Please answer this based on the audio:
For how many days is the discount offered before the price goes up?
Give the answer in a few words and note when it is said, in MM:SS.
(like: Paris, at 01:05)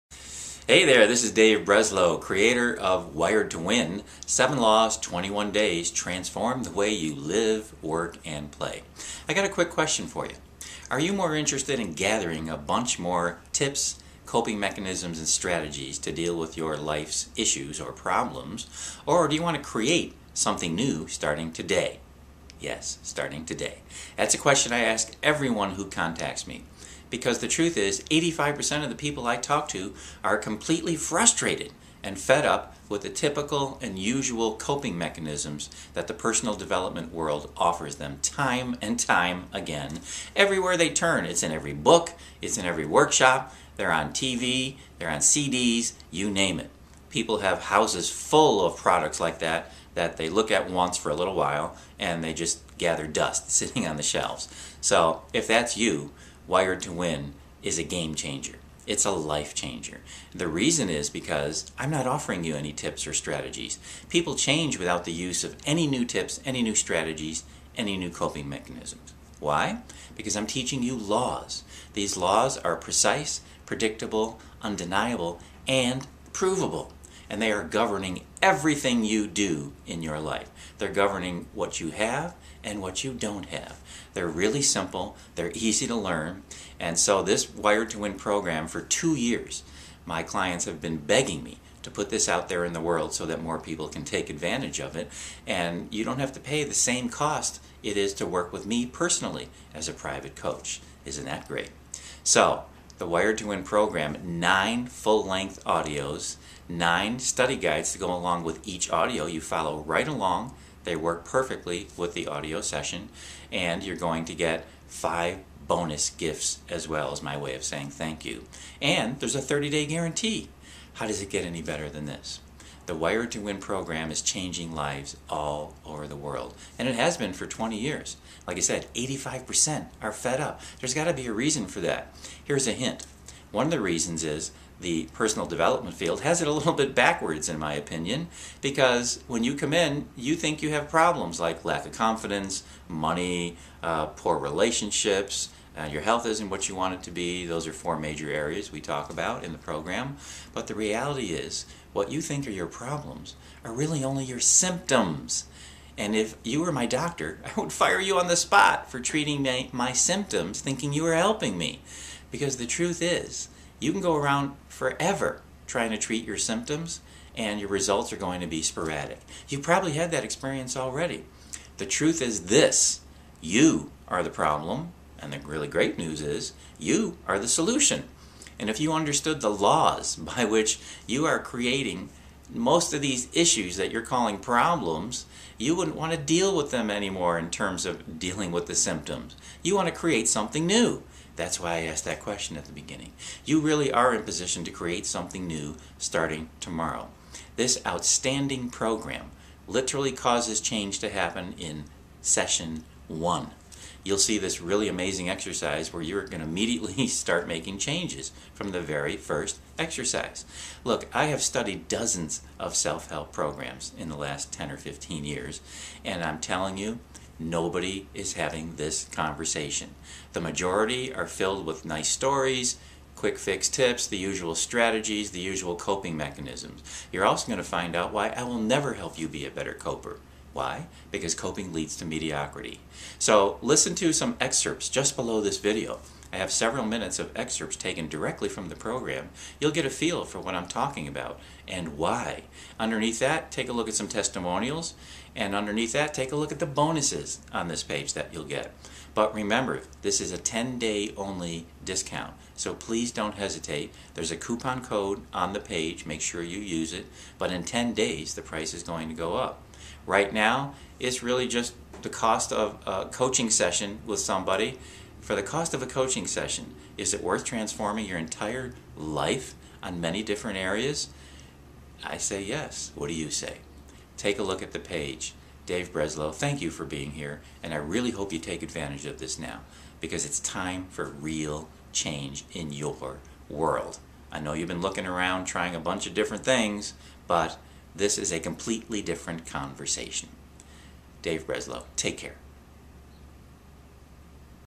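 10, at 04:10.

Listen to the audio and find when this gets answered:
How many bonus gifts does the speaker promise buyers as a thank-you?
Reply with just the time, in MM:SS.
01:54.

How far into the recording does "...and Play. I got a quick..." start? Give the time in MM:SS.
00:08.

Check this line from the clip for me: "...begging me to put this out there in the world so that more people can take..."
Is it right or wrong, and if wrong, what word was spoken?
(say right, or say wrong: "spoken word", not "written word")
right.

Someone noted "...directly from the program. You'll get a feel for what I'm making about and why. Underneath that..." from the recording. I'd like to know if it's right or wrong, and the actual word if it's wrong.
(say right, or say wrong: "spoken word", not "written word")
wrong: "talking", not "making".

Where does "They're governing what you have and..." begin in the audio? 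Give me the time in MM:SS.
01:20.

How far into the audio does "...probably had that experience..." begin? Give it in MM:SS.
02:49.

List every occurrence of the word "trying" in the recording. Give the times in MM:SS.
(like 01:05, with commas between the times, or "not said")
02:45, 04:45.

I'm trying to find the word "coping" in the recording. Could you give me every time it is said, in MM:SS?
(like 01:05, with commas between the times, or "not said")
00:14, 00:34, 01:08, 03:45, 03:51.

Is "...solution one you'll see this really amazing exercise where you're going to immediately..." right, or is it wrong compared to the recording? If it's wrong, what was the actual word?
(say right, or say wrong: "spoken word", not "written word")
wrong: "session", not "solution".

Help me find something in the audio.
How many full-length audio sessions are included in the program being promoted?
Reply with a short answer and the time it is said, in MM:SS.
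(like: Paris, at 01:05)
9, at 01:44.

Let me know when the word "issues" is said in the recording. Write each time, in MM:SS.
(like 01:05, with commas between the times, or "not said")
00:17, 03:03.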